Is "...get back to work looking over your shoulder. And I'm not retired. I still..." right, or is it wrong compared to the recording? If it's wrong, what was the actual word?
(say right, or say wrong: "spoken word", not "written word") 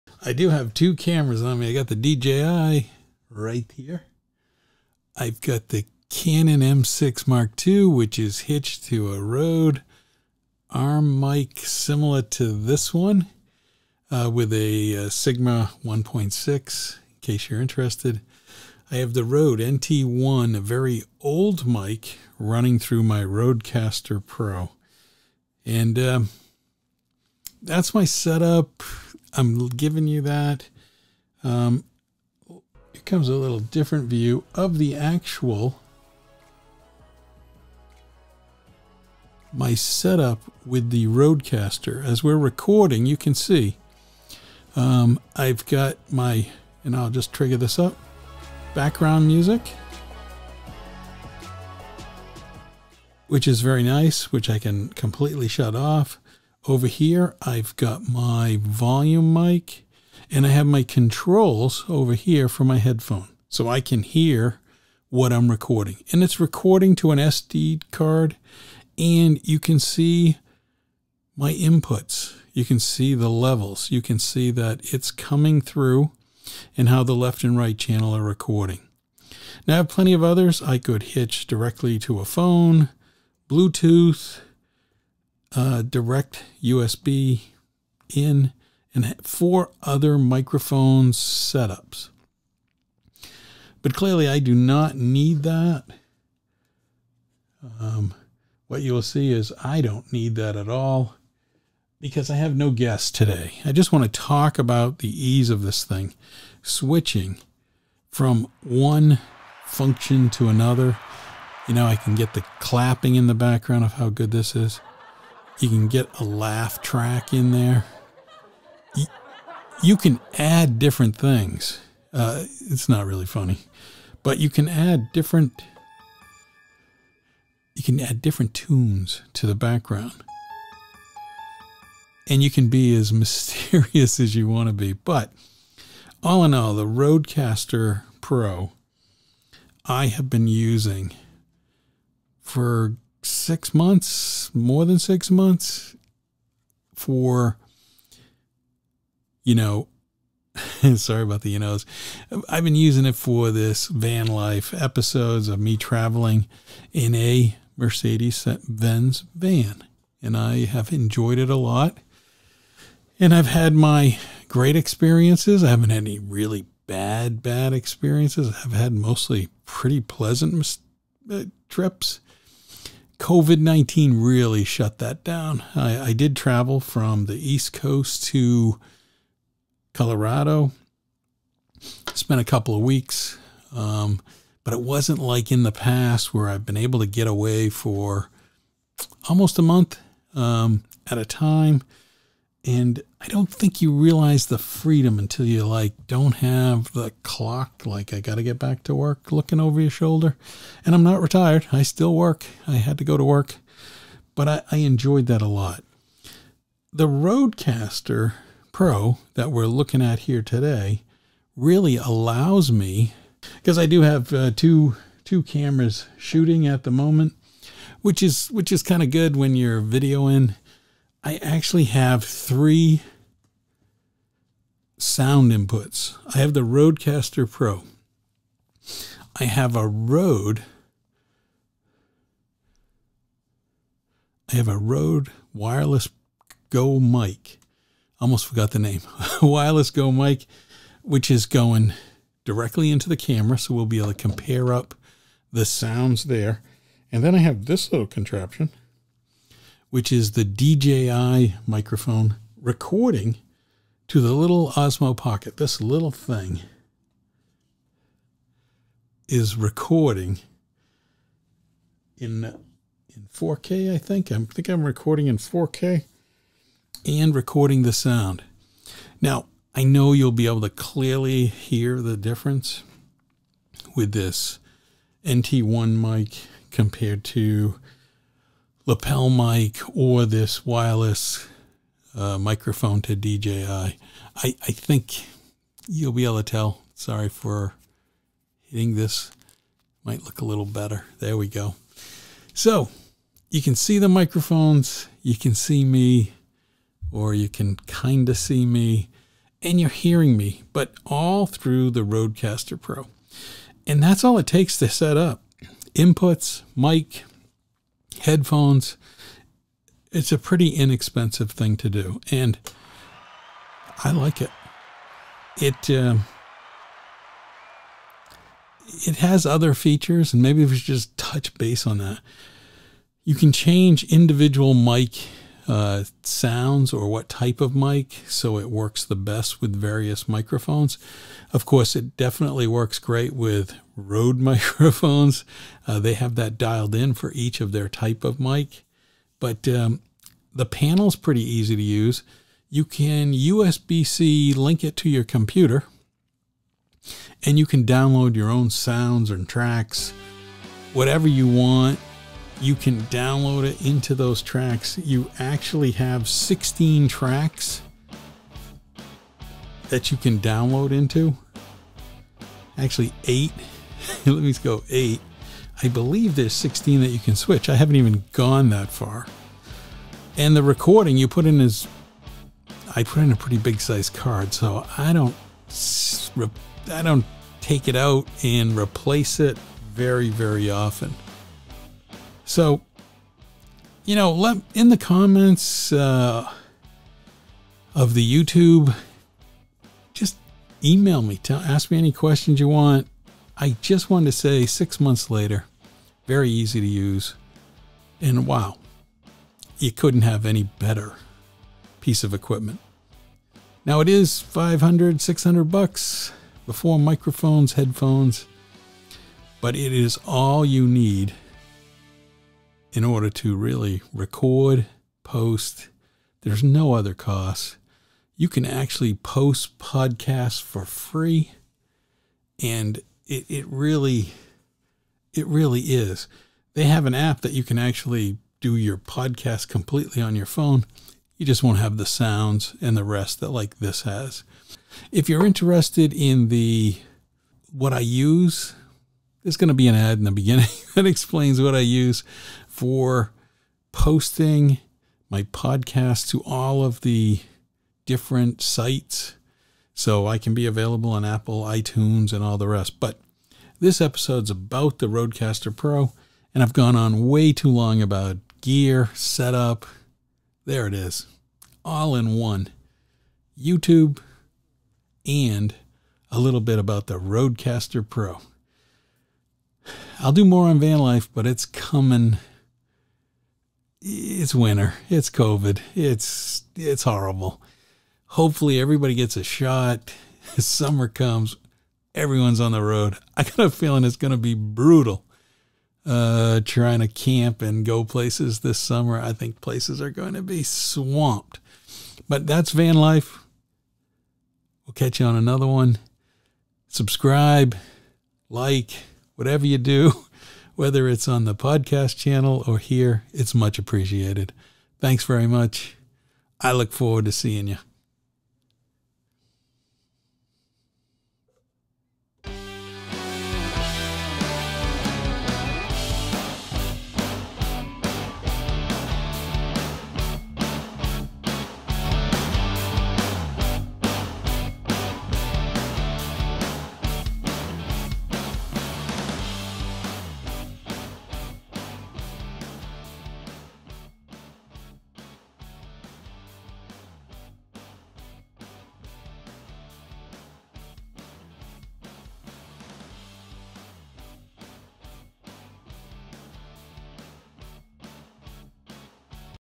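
right.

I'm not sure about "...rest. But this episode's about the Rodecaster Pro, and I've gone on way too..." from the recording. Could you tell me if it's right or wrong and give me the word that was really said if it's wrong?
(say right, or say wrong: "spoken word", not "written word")
right.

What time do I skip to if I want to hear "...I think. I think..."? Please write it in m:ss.
4:23.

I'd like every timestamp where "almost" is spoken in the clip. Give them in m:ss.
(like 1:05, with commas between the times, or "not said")
3:09, 3:58.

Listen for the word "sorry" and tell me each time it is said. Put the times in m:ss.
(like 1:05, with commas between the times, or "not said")
2:30, 4:46.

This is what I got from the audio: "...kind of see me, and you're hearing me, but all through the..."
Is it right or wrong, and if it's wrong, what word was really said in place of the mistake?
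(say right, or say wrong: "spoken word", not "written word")
right.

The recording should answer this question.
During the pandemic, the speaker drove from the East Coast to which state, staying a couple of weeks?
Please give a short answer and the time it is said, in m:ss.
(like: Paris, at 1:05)
Colorado, at 2:59.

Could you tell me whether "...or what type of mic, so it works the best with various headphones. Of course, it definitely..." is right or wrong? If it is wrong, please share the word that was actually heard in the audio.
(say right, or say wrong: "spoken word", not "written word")
wrong: "microphones", not "headphones".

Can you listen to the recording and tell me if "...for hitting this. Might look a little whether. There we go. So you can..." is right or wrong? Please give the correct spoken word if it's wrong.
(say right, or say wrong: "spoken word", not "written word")
wrong: "better", not "whether".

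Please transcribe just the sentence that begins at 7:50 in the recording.
I'll do more on van life, but it's coming it's winter.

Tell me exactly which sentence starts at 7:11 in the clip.
You just won't have the sounds and the rest that like this has.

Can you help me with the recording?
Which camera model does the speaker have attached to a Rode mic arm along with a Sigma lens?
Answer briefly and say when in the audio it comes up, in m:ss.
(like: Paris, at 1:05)
Canon M6 Mark II, at 0:06.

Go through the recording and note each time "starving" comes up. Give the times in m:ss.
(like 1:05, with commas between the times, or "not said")
not said.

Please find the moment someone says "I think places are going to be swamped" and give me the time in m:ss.
8:09.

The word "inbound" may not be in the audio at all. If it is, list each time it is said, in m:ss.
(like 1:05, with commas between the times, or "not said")
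not said.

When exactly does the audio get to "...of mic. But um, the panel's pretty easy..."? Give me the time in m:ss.
5:38.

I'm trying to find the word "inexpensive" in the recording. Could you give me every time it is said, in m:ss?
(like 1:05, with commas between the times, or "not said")
5:10.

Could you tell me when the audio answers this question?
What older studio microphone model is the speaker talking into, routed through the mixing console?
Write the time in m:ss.
0:19.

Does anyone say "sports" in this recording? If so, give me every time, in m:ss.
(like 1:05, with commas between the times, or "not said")
not said.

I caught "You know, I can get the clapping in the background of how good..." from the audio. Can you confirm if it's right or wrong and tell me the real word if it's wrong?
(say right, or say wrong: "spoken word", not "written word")
right.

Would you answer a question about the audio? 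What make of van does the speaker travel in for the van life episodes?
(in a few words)
Mercedes Benz.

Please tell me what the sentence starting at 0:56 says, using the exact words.
Over here, I've got my volume mic and I have my controls over here for my headphone.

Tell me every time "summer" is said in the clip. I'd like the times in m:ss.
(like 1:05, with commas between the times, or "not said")
8:00, 8:08.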